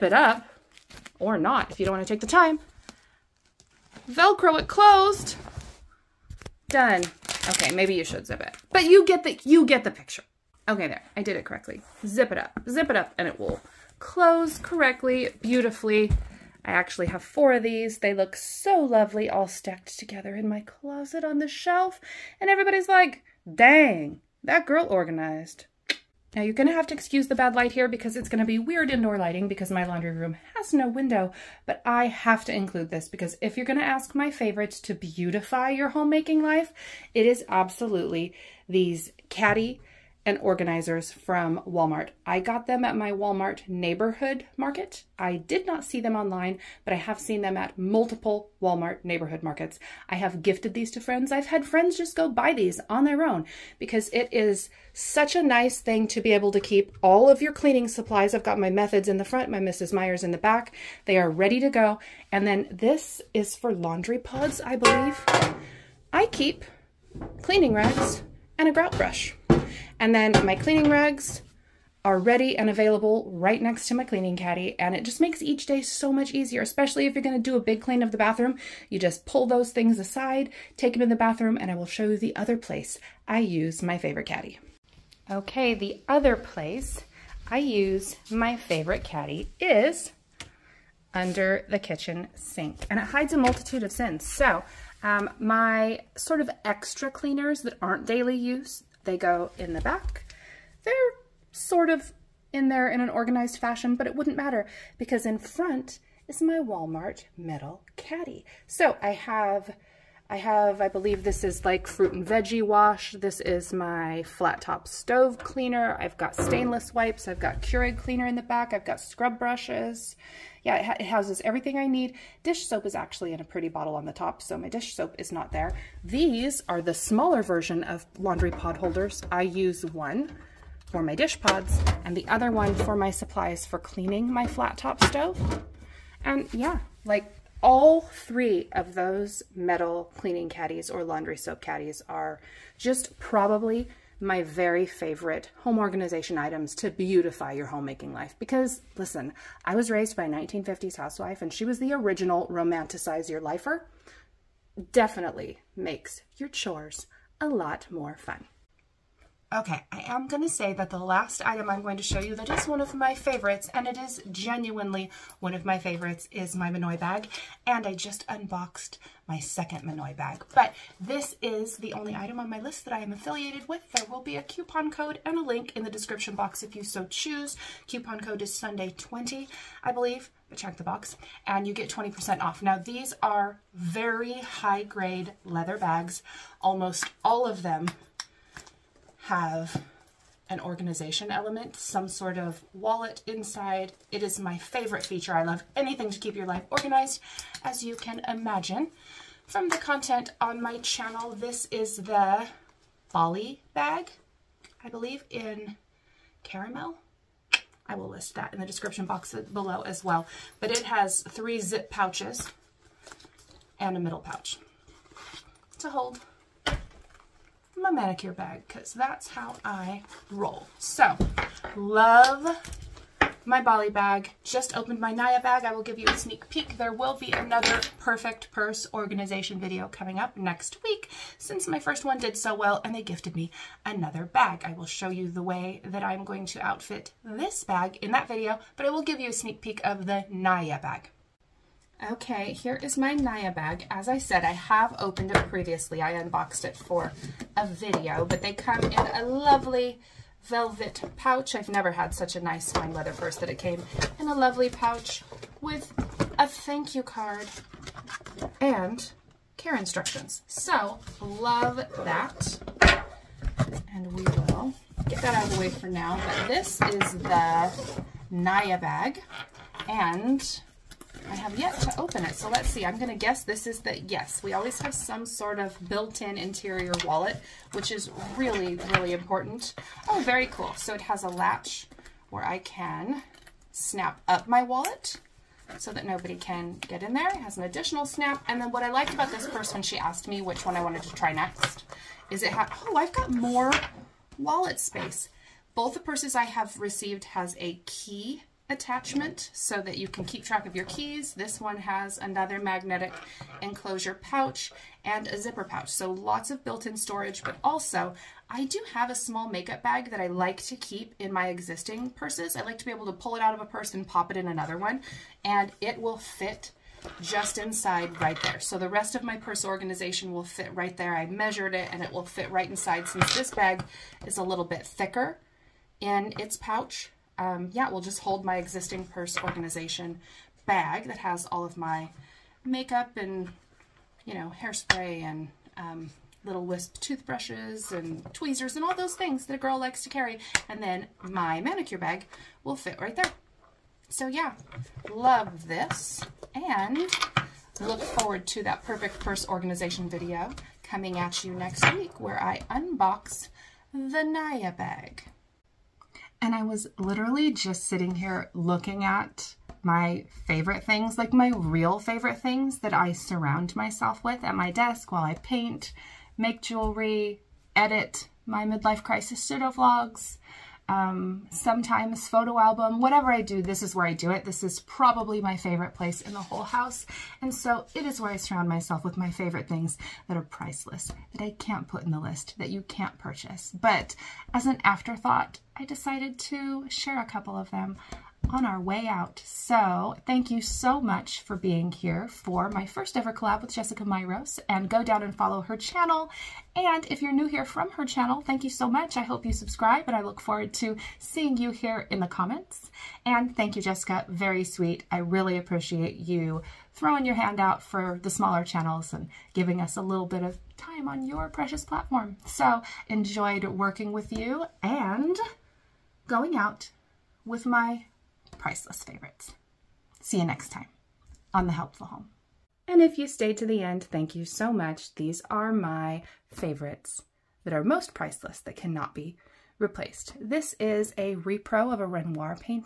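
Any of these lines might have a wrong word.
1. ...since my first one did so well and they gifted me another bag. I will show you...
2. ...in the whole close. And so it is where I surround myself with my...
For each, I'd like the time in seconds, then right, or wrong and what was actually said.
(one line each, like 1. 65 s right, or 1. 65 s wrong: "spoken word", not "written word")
1. 231 s right
2. 376 s wrong: "house", not "close".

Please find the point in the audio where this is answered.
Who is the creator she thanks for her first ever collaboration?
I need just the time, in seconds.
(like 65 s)
393 s.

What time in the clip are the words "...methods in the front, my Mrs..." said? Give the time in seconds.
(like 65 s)
58 s.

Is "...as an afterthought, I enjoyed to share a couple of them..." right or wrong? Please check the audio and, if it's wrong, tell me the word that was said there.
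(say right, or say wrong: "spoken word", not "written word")
wrong: "decided", not "enjoyed".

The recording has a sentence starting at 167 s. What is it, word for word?
And I just unboxed my second Minooy bag.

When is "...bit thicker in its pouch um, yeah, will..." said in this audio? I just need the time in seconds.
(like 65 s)
324 s.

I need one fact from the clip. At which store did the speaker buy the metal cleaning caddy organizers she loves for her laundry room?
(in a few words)
Walmart neighborhood market.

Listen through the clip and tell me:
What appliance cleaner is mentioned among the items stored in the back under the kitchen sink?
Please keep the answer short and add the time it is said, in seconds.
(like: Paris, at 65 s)
Keurig cleaner, at 117 s.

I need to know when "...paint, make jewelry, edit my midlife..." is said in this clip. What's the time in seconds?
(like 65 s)
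365 s.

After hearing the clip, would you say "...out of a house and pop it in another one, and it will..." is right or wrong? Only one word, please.
wrong.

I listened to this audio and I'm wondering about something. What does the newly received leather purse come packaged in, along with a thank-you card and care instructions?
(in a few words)
velvet pouch.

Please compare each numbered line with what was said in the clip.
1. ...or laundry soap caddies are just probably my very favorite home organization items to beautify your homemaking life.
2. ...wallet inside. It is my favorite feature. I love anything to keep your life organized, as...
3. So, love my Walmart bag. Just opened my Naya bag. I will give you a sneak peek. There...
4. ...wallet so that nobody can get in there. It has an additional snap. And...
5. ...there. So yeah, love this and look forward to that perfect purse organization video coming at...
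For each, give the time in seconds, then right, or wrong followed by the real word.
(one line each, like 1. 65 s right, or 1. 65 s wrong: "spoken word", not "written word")
1. 140 s right
2. 192 s right
3. 220 s wrong: "Bali", not "Walmart"
4. 284 s right
5. 343 s right.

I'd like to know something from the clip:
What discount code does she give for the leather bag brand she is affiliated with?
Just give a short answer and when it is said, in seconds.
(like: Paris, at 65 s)
Sunday20, at 178 s.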